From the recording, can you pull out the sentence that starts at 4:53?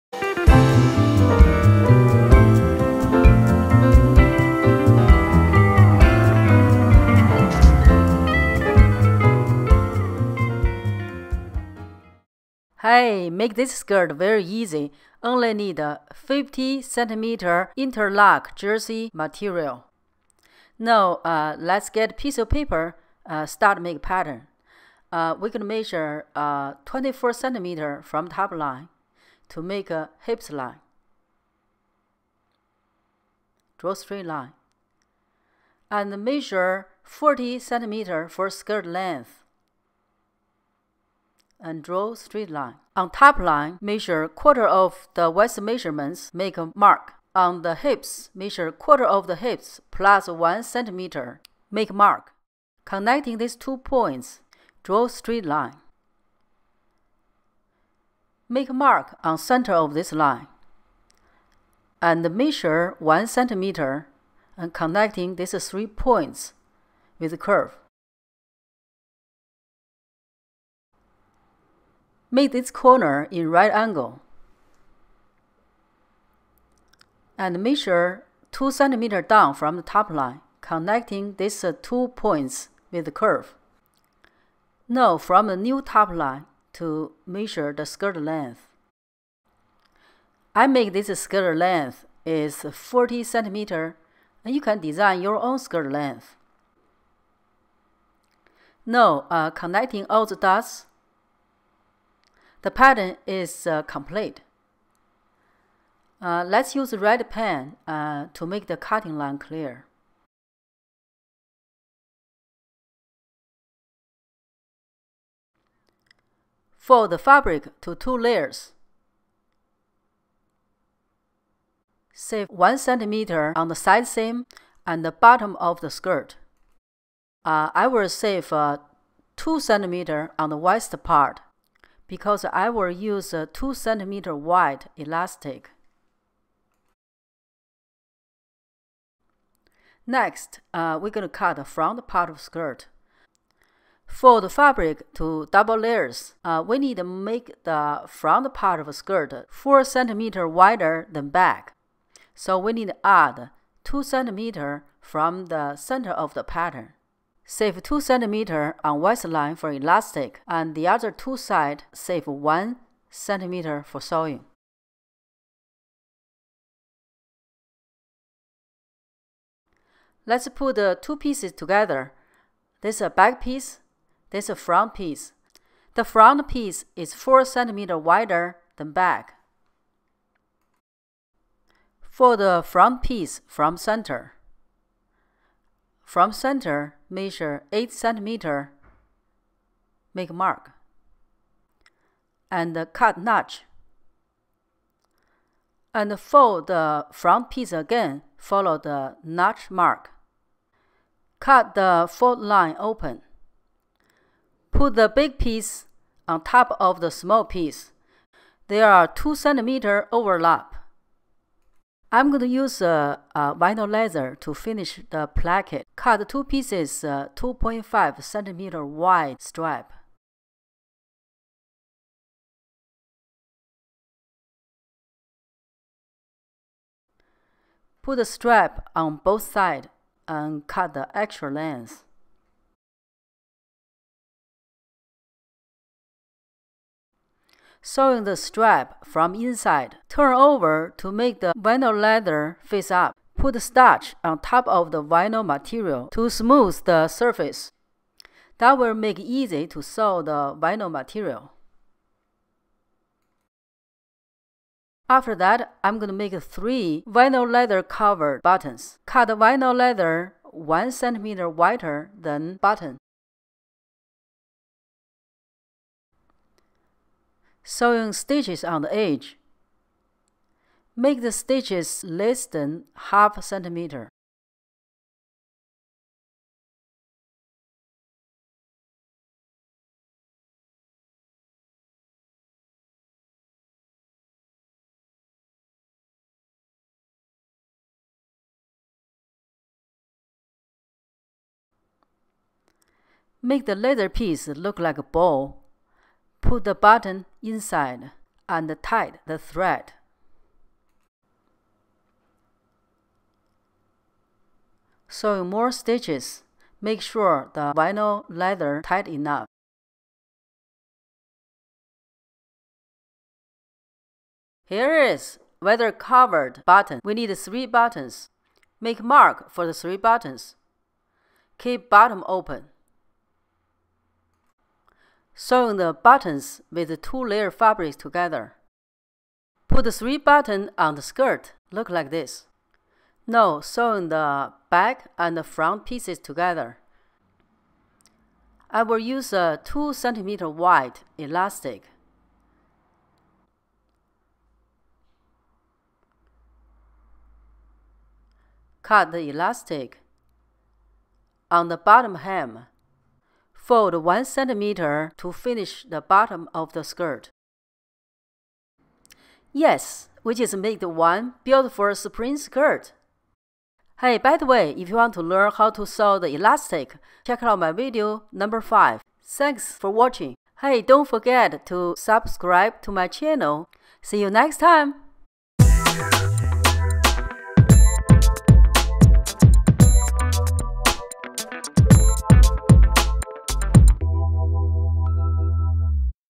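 Make the leather piece look like a ball.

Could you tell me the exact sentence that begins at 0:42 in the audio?
On top line, measure quarter of the waist measurements, make a mark.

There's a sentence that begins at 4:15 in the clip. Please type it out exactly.
After that, I'm going to make three vinyl leather covered buttons.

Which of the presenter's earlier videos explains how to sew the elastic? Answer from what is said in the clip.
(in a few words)
video number 5.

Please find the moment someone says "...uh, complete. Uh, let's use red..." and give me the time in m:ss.
1:43.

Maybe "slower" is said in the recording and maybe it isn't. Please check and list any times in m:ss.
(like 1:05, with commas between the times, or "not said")
not said.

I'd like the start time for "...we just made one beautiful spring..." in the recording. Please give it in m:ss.
6:00.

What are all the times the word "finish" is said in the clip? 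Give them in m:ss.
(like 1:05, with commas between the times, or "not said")
3:34, 5:55.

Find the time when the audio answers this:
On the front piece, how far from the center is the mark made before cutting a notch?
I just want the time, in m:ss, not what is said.
3:07.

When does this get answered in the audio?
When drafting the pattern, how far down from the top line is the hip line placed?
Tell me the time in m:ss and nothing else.
0:26.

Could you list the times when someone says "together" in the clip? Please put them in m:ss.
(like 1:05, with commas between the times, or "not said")
2:51, 5:27, 5:36.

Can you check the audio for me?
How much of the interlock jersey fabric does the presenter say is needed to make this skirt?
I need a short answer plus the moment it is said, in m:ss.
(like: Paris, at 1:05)
50 centimeters, at 0:16.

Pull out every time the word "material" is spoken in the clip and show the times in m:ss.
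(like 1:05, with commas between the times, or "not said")
0:19, 4:05, 4:10.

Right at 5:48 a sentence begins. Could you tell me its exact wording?
Cut the elastic on the bottom hem.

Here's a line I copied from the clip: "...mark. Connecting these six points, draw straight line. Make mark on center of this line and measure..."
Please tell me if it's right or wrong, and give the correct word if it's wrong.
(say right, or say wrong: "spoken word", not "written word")
wrong: "two", not "six".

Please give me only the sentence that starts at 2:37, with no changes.
Save 2 cm on waistline for elastic and the other two side save 1 cm for sewing.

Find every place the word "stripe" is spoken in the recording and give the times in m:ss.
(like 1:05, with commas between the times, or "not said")
3:39, 3:48.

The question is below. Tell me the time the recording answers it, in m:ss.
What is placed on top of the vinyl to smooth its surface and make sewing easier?
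4:03.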